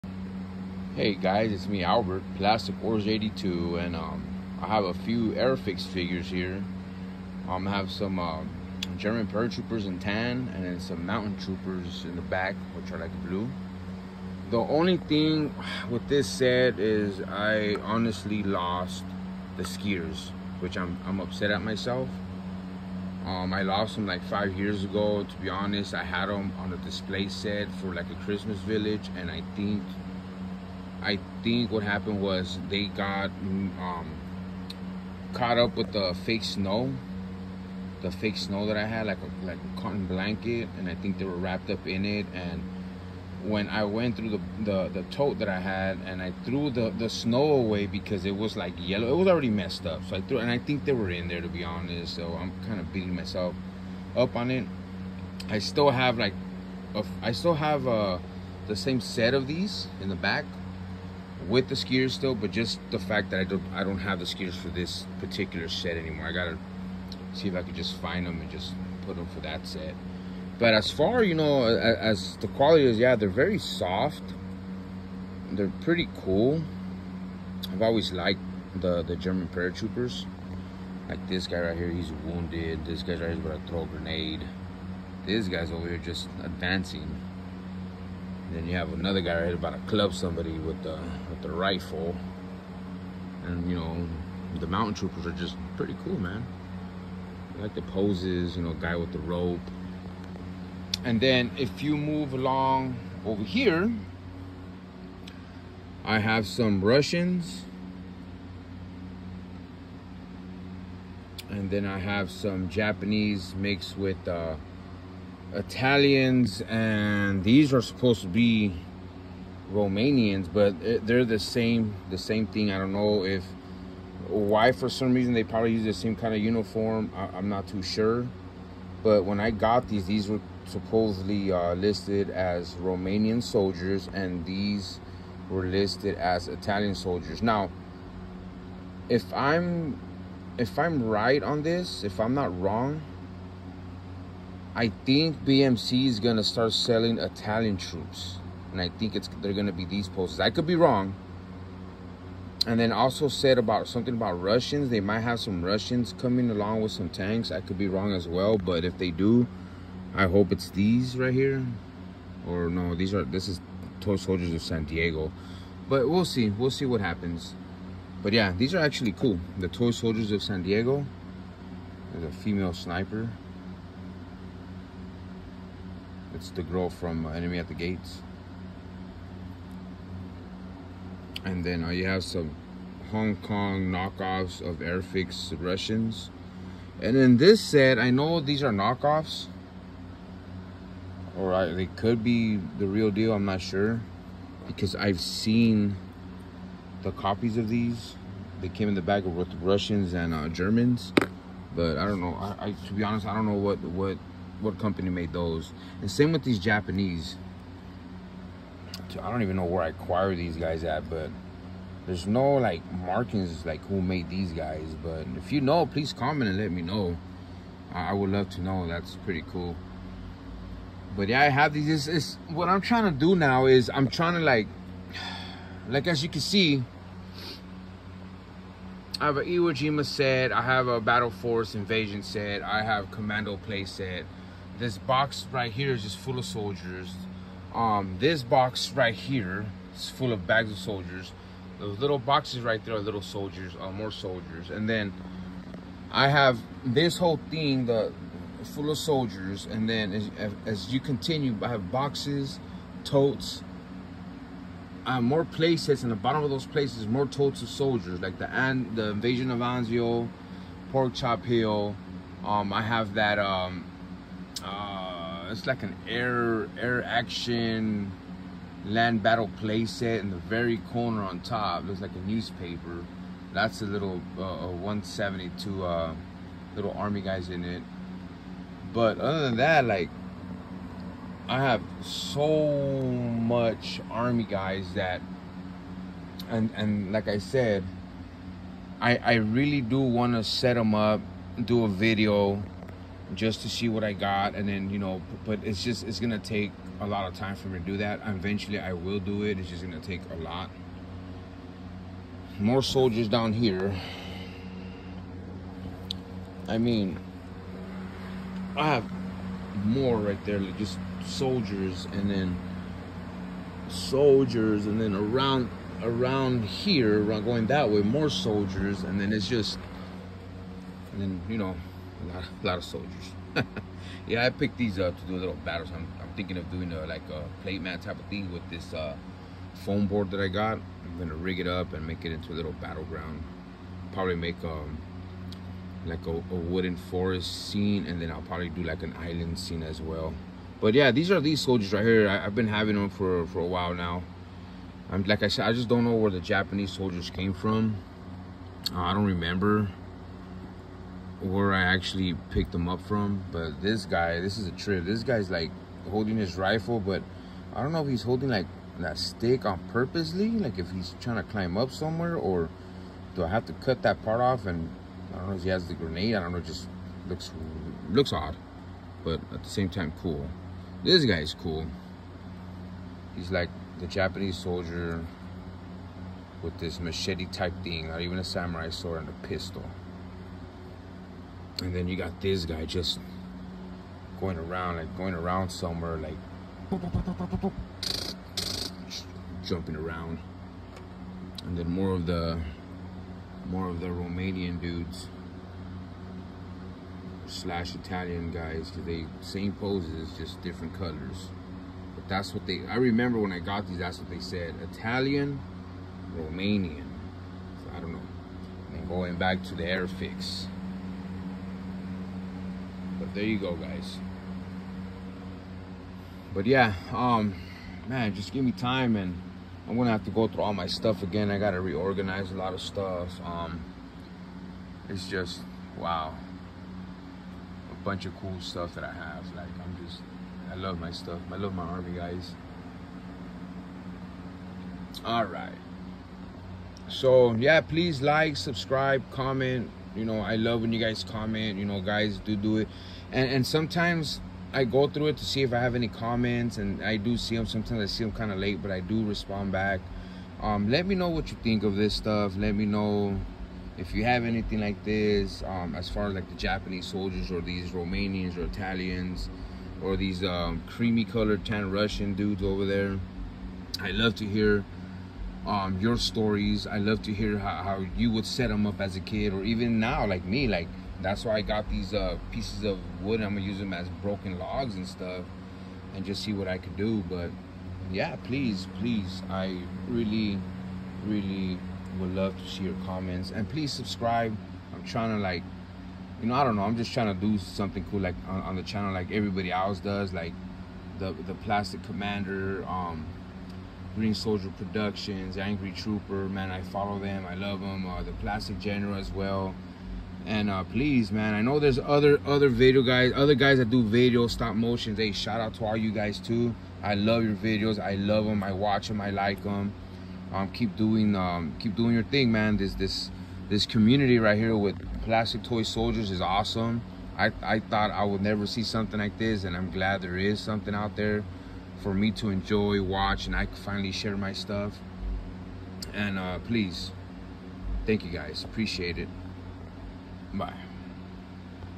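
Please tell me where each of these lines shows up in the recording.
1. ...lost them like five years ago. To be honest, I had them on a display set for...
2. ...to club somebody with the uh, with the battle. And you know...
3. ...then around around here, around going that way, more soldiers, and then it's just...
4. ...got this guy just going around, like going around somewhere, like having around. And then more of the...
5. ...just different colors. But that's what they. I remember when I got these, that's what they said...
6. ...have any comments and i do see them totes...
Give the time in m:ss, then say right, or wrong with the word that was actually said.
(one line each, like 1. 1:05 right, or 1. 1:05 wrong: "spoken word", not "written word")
1. 0:23 right
2. 1:29 wrong: "rifle", not "battle"
3. 5:14 right
4. 6:22 wrong: "jumping", not "having"
5. 6:40 right
6. 7:25 wrong: "sometimes", not "totes".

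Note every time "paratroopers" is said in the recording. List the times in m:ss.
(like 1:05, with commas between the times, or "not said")
0:09, 1:19.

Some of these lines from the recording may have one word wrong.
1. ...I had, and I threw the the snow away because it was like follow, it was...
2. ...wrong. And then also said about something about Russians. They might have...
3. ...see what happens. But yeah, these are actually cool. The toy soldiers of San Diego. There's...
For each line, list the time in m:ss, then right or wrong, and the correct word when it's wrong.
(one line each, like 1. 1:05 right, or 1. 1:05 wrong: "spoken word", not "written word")
1. 0:45 wrong: "yellow", not "follow"
2. 2:30 right
3. 2:46 right.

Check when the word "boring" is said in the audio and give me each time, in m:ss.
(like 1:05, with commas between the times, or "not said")
not said.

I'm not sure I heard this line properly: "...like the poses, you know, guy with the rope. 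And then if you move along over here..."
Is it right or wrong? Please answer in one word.
right.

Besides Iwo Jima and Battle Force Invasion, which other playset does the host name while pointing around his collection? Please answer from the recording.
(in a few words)
Commando.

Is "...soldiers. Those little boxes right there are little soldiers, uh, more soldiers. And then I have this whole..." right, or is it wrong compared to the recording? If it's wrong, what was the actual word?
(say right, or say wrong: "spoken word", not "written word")
right.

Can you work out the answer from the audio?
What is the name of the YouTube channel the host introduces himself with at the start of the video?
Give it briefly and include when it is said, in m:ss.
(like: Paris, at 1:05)
Plastic Wars 82, at 0:02.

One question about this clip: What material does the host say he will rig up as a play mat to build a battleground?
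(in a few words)
foam board.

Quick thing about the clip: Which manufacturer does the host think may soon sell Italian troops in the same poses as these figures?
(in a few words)
BMC.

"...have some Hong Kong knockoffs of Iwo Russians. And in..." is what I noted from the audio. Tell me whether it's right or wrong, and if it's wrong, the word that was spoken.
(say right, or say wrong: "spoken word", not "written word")
wrong: "Airfix", not "Iwo".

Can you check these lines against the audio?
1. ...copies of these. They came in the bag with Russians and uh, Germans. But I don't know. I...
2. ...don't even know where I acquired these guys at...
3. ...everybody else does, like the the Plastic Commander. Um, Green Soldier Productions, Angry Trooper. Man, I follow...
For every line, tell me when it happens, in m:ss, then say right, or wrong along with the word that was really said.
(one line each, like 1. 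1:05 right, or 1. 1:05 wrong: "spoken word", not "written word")
1. 3:17 right
2. 3:29 right
3. 8:09 right.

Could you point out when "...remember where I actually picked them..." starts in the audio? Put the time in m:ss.
5:49.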